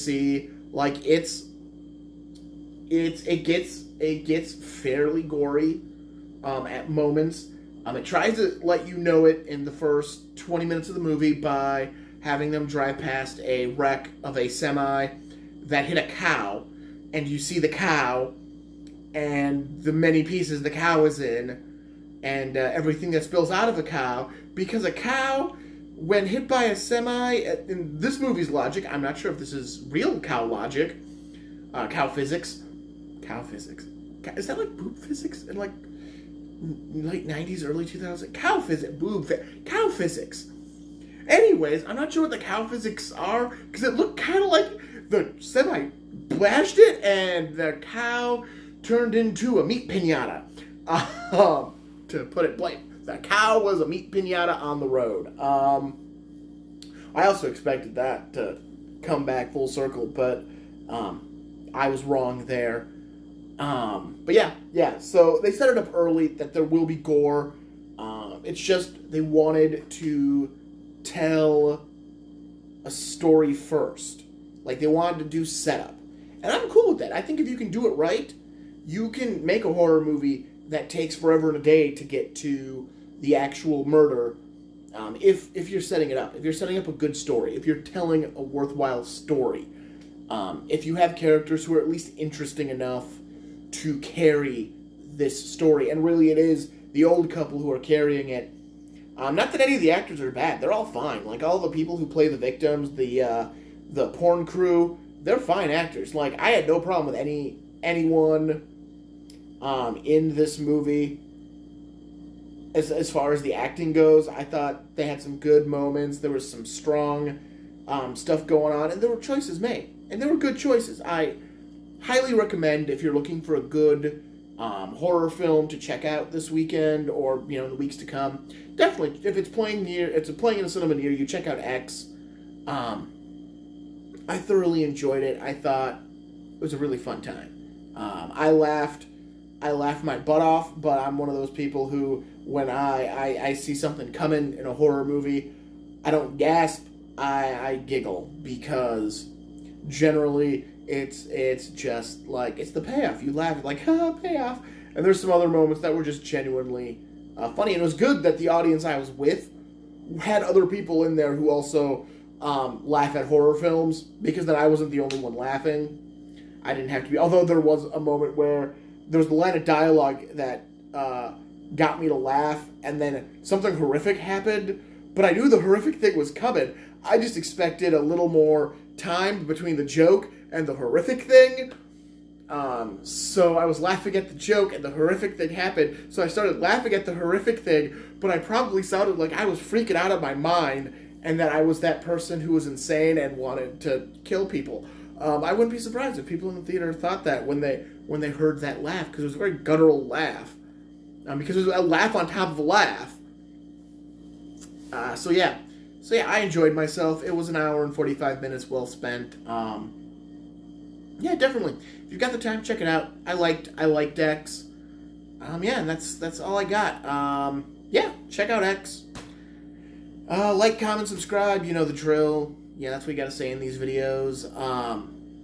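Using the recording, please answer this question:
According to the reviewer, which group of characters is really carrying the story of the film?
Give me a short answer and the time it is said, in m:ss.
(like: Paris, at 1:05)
The old couple, at 1:36.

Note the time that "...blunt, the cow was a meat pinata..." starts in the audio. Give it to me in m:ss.
0:52.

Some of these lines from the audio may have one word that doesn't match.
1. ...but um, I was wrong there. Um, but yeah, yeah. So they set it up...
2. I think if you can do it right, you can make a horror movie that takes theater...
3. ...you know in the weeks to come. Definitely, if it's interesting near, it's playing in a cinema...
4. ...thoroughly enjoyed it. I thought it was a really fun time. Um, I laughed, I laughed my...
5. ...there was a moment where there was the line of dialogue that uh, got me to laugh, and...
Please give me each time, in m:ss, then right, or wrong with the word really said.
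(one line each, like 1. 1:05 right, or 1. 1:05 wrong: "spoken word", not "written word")
1. 1:00 right
2. 1:17 wrong: "forever", not "theater"
3. 2:07 wrong: "playing", not "interesting"
4. 2:14 right
5. 2:47 right.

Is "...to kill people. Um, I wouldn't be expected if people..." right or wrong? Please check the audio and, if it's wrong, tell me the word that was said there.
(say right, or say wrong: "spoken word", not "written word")
wrong: "surprised", not "expected".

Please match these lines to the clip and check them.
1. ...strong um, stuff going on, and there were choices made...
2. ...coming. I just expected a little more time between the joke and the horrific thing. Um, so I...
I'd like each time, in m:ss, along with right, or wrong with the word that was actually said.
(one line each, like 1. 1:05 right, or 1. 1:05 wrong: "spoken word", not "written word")
1. 1:56 right
2. 2:56 right.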